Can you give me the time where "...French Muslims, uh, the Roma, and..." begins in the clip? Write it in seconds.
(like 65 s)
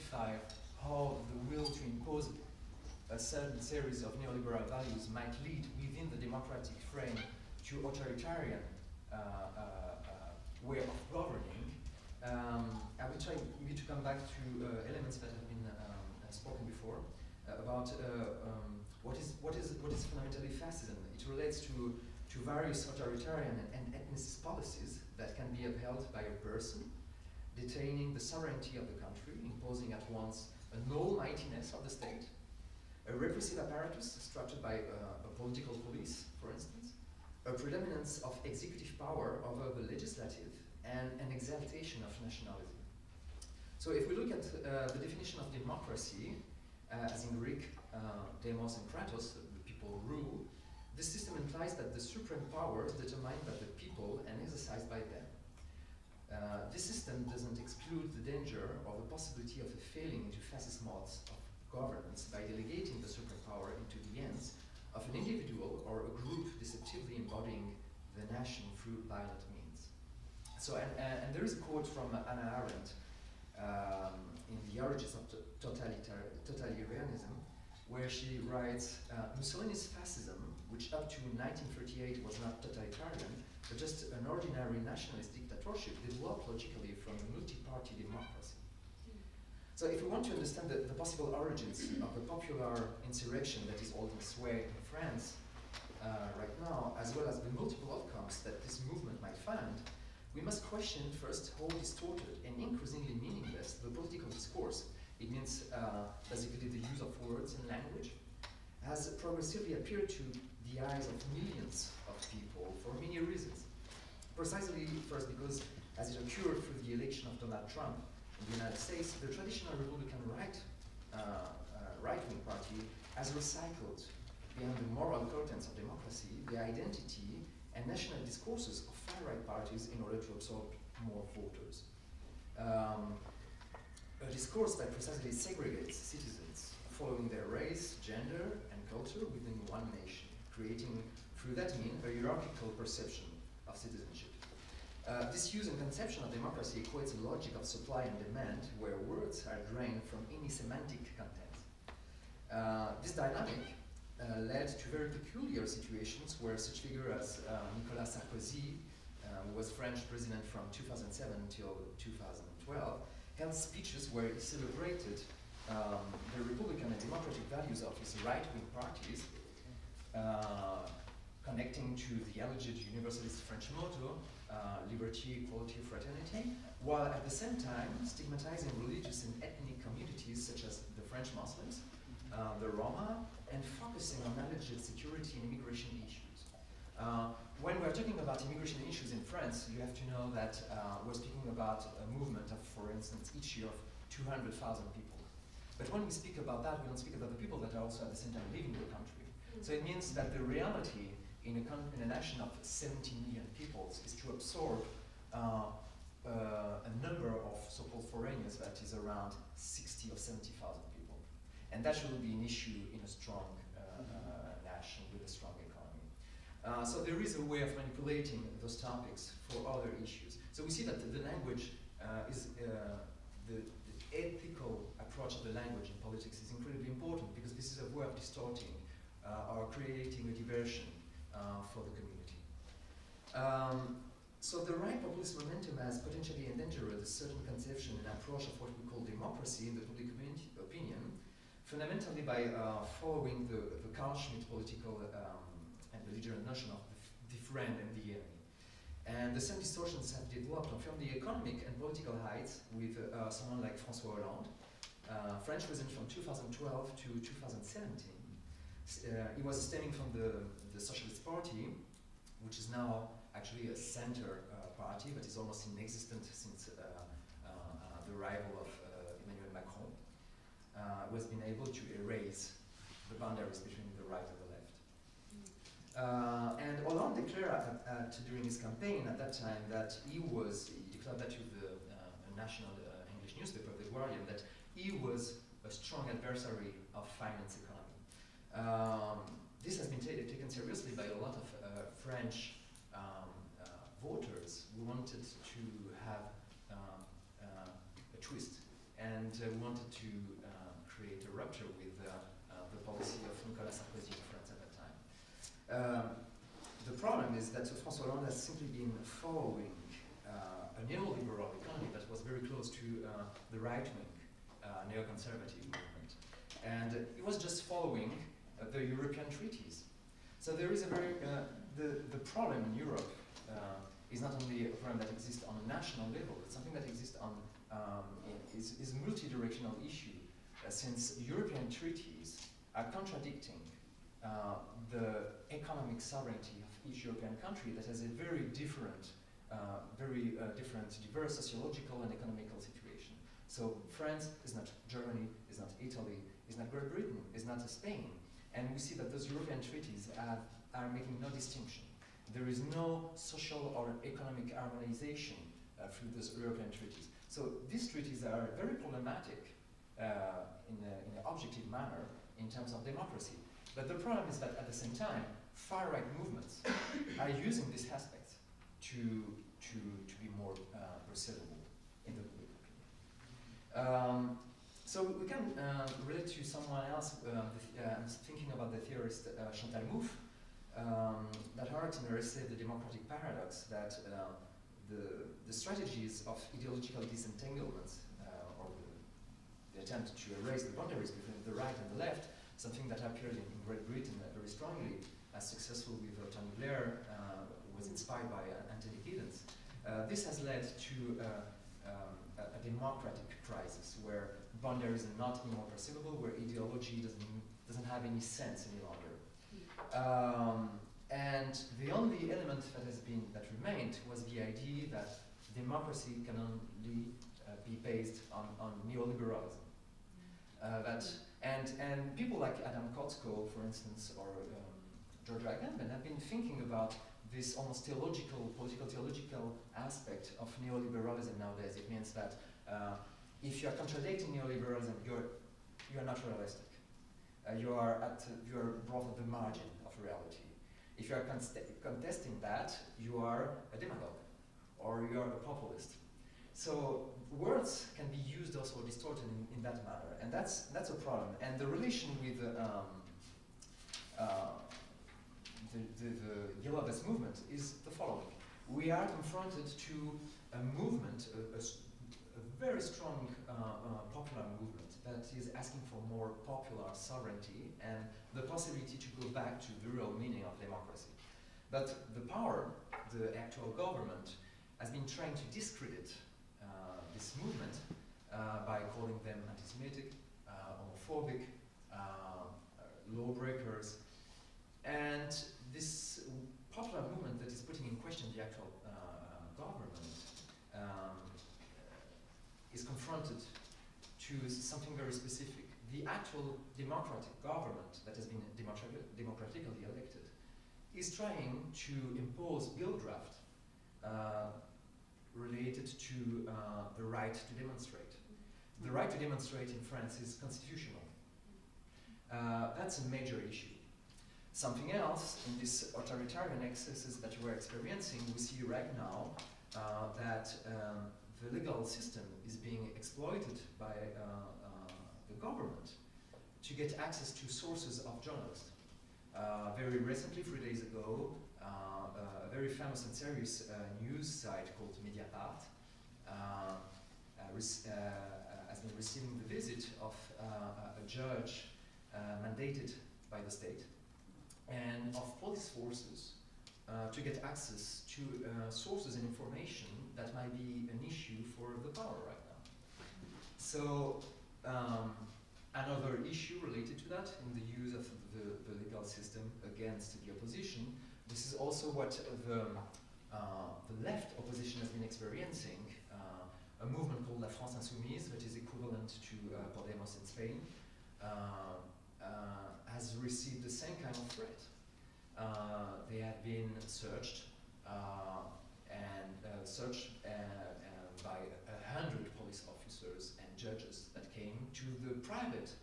181 s.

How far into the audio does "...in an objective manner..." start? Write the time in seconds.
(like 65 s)
360 s.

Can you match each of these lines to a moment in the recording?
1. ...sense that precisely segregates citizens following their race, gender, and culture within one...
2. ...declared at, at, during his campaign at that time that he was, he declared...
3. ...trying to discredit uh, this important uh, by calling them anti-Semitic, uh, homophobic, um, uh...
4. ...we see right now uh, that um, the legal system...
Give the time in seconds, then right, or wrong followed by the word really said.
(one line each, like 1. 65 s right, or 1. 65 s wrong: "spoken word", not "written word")
1. 134 s wrong: "discourse", not "sense"
2. 277 s right
3. 475 s wrong: "movement", not "important"
4. 518 s right.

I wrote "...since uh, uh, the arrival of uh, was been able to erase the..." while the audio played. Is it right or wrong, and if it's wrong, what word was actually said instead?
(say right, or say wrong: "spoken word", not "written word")
right.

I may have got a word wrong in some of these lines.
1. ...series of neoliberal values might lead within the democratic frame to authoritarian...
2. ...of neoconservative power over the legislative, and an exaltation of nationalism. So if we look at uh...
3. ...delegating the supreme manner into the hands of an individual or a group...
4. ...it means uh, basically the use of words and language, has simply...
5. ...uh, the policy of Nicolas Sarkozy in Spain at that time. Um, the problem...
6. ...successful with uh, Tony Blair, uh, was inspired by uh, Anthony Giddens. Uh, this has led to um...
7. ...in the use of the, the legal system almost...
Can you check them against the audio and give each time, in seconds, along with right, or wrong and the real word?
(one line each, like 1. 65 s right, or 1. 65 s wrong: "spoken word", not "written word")
1. 3 s right
2. 38 s wrong: "executive", not "neoconservative"
3. 62 s wrong: "power", not "manner"
4. 105 s wrong: "progressively", not "simply"
5. 302 s wrong: "France", not "Spain"
6. 395 s right
7. 557 s wrong: "against", not "almost".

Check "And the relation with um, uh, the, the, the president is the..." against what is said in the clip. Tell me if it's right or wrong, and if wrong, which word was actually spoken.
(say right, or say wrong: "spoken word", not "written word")
wrong: "movement", not "president".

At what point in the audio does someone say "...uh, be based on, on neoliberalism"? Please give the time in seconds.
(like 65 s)
417 s.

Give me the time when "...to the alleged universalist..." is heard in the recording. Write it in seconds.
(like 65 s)
171 s.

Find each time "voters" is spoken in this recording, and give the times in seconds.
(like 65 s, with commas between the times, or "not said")
131 s, 294 s.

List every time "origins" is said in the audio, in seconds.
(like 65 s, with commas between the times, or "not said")
74 s, 91 s.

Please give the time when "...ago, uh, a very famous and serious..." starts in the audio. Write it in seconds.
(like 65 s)
530 s.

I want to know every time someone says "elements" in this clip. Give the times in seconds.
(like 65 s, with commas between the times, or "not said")
14 s, 412 s.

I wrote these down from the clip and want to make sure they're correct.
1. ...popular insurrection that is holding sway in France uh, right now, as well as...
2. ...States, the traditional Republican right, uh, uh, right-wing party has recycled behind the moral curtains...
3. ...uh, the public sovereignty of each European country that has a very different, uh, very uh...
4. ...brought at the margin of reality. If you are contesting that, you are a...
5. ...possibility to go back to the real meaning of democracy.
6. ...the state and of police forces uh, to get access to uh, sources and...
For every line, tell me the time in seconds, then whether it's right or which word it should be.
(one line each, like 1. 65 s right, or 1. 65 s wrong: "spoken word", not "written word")
1. 92 s right
2. 118 s right
3. 334 s wrong: "economic", not "public"
4. 438 s right
5. 468 s right
6. 543 s right.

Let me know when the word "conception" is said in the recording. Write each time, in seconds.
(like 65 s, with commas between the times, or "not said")
145 s, 237 s.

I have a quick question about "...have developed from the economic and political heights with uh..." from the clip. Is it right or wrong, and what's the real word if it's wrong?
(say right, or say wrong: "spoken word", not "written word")
right.